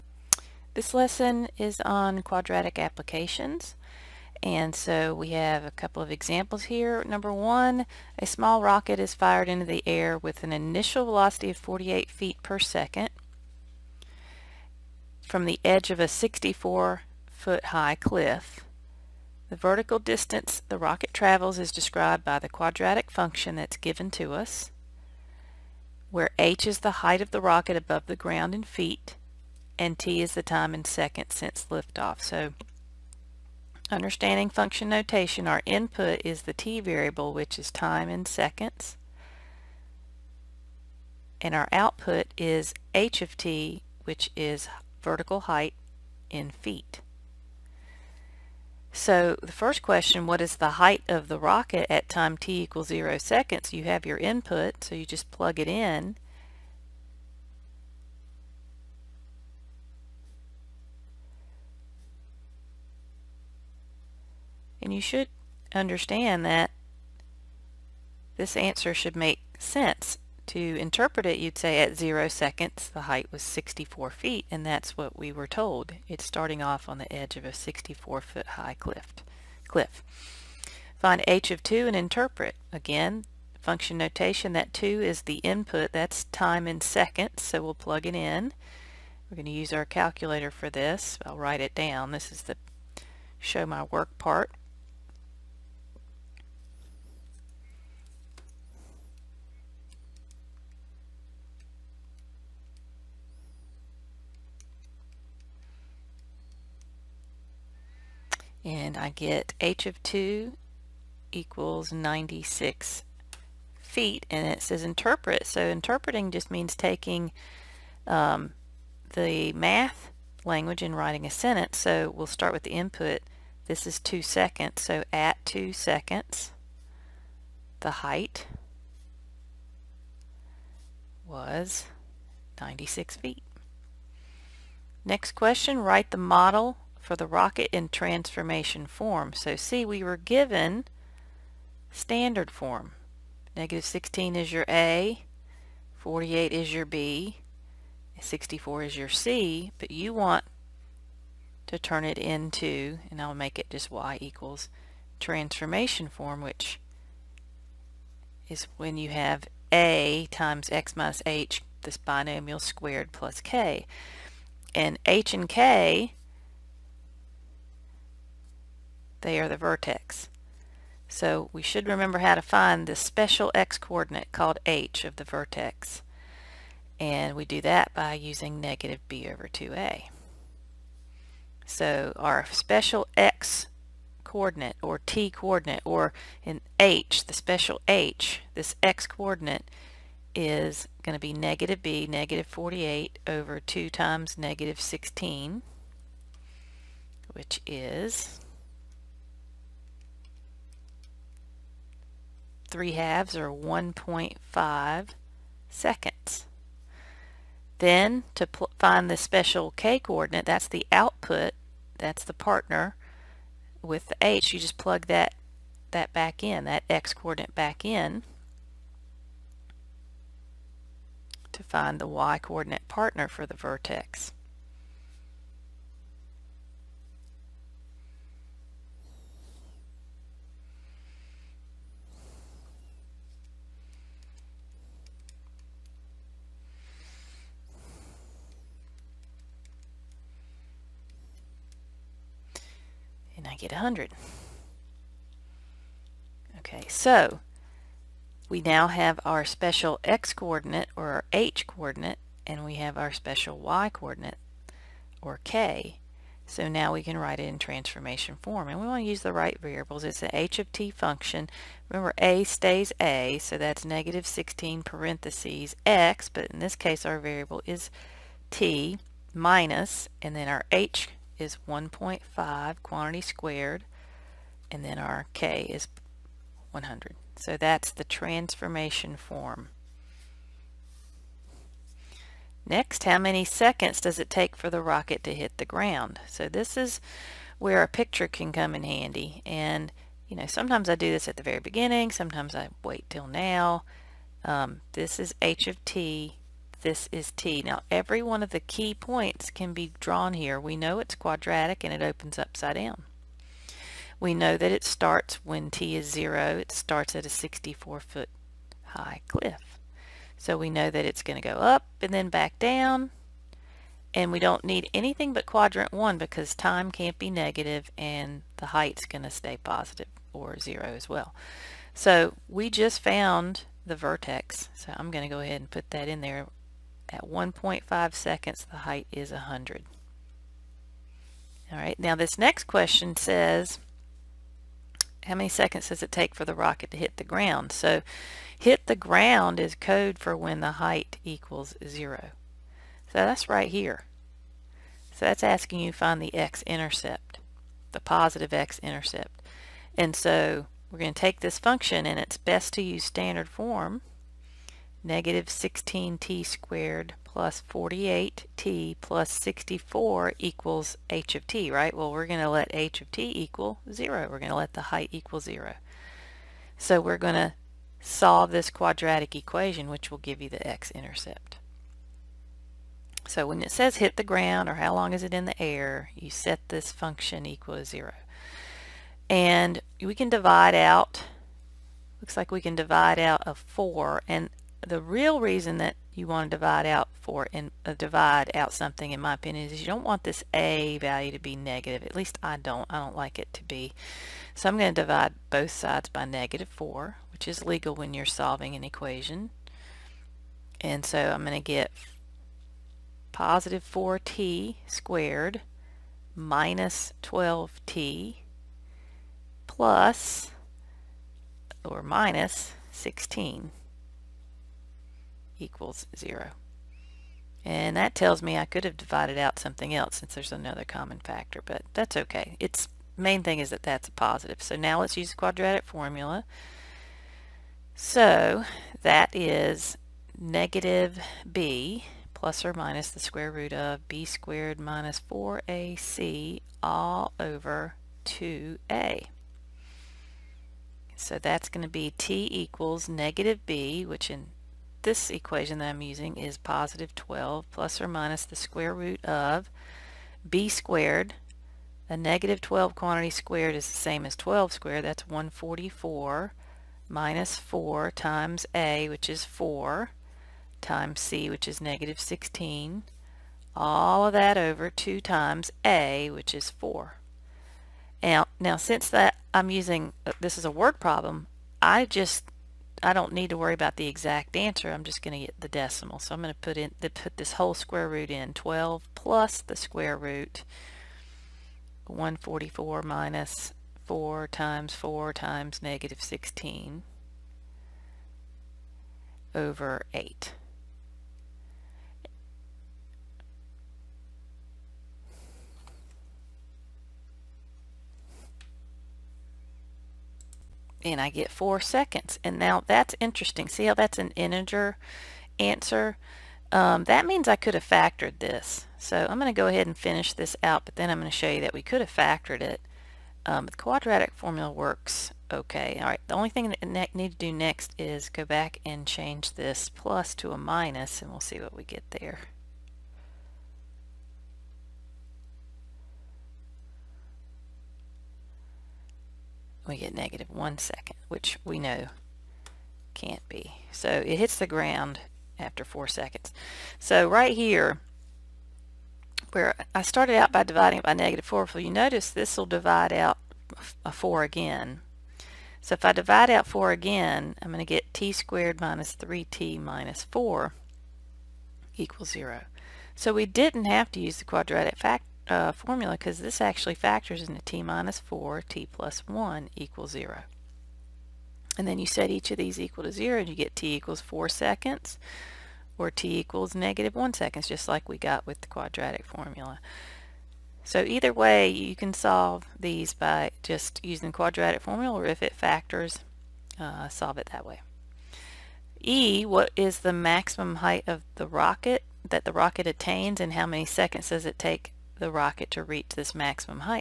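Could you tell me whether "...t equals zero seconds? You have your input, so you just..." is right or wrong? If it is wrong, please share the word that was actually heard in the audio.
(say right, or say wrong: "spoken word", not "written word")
right.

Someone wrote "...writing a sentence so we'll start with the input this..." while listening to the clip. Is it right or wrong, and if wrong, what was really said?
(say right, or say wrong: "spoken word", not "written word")
right.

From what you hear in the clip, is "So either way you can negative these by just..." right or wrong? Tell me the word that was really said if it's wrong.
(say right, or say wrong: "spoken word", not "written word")
wrong: "solve", not "negative".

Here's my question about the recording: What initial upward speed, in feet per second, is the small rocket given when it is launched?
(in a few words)
48 feet per second.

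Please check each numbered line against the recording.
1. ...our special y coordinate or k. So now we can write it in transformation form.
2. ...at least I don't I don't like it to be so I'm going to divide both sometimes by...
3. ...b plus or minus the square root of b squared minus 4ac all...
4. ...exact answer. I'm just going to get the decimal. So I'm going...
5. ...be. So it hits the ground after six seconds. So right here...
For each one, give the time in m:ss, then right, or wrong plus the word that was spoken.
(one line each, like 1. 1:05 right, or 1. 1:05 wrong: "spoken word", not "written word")
1. 4:12 right
2. 6:32 wrong: "sides", not "sometimes"
3. 7:11 right
4. 7:54 right
5. 8:53 wrong: "four", not "six".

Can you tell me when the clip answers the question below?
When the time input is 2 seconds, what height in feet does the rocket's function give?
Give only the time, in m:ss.
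1:49.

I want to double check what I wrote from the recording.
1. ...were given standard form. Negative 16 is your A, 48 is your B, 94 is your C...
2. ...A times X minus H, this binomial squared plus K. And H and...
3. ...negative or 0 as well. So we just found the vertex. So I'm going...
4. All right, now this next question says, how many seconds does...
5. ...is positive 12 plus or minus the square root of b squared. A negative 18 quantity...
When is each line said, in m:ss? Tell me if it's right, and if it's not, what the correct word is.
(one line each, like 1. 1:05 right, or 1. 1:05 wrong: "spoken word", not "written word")
1. 2:20 wrong: "64", not "94"
2. 2:39 right
3. 5:19 wrong: "positive", not "negative"
4. 5:31 right
5. 7:26 wrong: "12", not "18".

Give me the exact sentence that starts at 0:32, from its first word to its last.
So understanding function notation, our input is the t variable, which is time in seconds.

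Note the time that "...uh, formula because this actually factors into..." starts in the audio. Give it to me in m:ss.
9:15.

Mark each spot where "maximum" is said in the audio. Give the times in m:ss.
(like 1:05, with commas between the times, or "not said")
9:40, 9:46.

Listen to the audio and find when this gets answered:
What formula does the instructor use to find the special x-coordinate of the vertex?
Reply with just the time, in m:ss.
2:58.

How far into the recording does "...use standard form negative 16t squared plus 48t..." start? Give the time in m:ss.
5:52.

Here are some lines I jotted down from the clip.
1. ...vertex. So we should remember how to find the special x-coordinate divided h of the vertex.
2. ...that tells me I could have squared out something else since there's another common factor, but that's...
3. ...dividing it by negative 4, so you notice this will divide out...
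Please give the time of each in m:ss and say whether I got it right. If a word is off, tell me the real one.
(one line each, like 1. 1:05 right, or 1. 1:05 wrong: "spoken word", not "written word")
1. 2:49 wrong: "called", not "divided"
2. 6:57 wrong: "divided", not "squared"
3. 9:00 right.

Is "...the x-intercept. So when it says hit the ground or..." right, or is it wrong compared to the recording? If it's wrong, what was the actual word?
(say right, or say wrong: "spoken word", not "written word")
right.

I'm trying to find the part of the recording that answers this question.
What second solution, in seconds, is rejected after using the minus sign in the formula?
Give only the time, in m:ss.
8:50.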